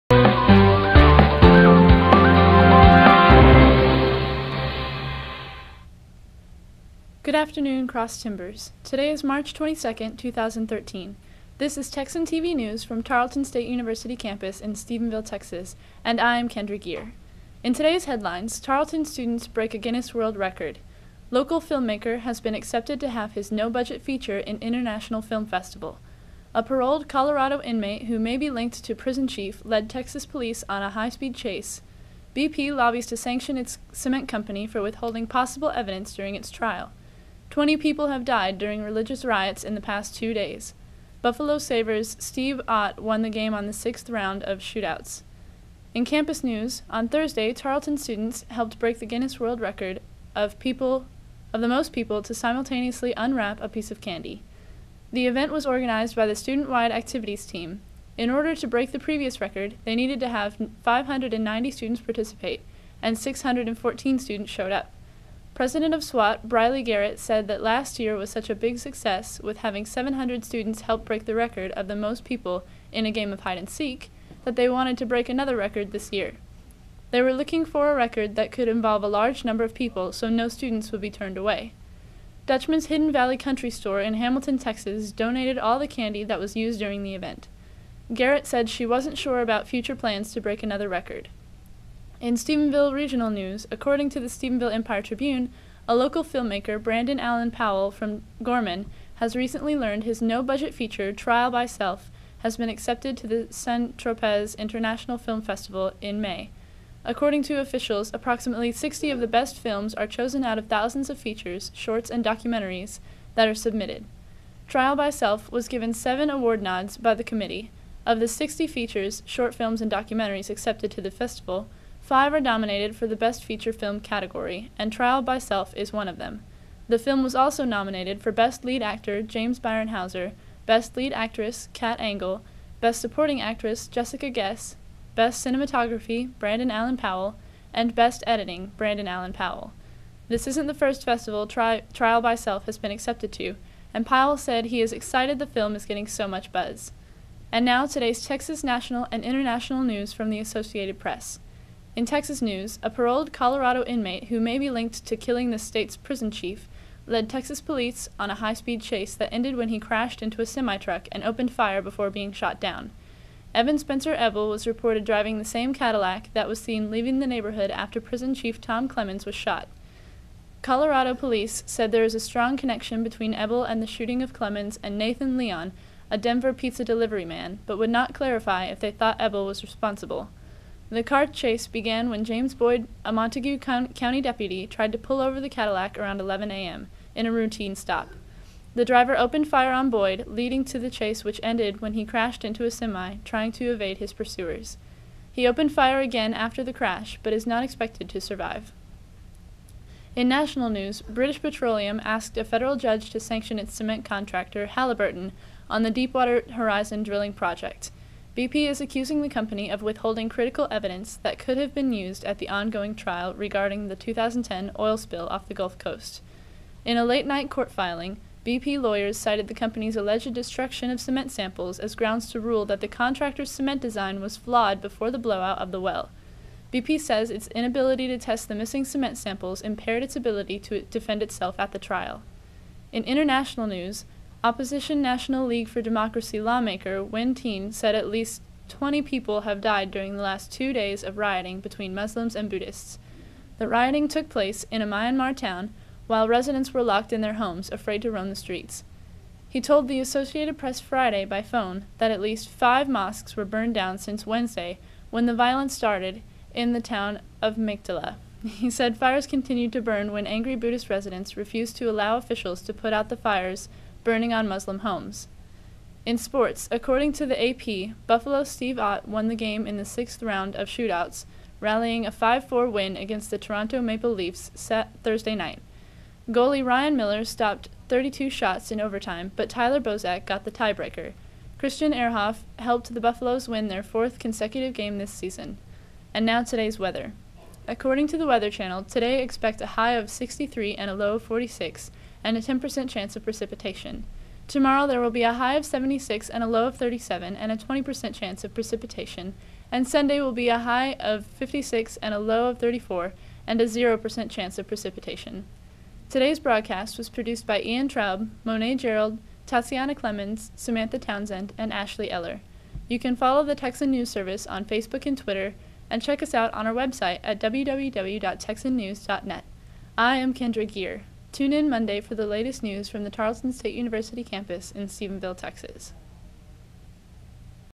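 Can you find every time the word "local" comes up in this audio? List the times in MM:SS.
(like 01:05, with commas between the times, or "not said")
00:21, 01:35.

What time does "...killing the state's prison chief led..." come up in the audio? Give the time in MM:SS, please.
02:35.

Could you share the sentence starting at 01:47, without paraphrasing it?
According to officials, approximately 60 of the best films are chosen out of thousands of features, shorts, and documentaries that are submitted.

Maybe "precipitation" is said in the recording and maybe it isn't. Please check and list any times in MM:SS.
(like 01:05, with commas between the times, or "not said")
04:53, 04:58, 05:04.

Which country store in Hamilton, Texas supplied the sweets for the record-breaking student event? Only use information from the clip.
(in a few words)
Dutchman's Hidden Valley Country Store.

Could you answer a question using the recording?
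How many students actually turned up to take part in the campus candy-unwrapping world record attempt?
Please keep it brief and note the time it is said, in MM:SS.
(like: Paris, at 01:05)
614, at 01:03.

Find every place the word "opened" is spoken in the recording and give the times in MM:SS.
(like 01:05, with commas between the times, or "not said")
02:41, 03:09, 03:15.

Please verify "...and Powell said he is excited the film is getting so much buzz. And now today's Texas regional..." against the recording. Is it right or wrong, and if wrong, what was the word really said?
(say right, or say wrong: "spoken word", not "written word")
wrong: "national", not "regional".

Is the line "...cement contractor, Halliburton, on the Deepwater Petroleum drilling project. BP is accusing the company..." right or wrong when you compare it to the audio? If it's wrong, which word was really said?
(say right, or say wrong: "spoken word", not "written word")
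wrong: "Horizon", not "Petroleum".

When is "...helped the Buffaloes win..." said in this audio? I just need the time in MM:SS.
04:42.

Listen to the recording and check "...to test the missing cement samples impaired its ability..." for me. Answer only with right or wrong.
right.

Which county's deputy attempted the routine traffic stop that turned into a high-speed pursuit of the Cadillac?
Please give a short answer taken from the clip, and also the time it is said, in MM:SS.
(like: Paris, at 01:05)
Montague County, at 03:03.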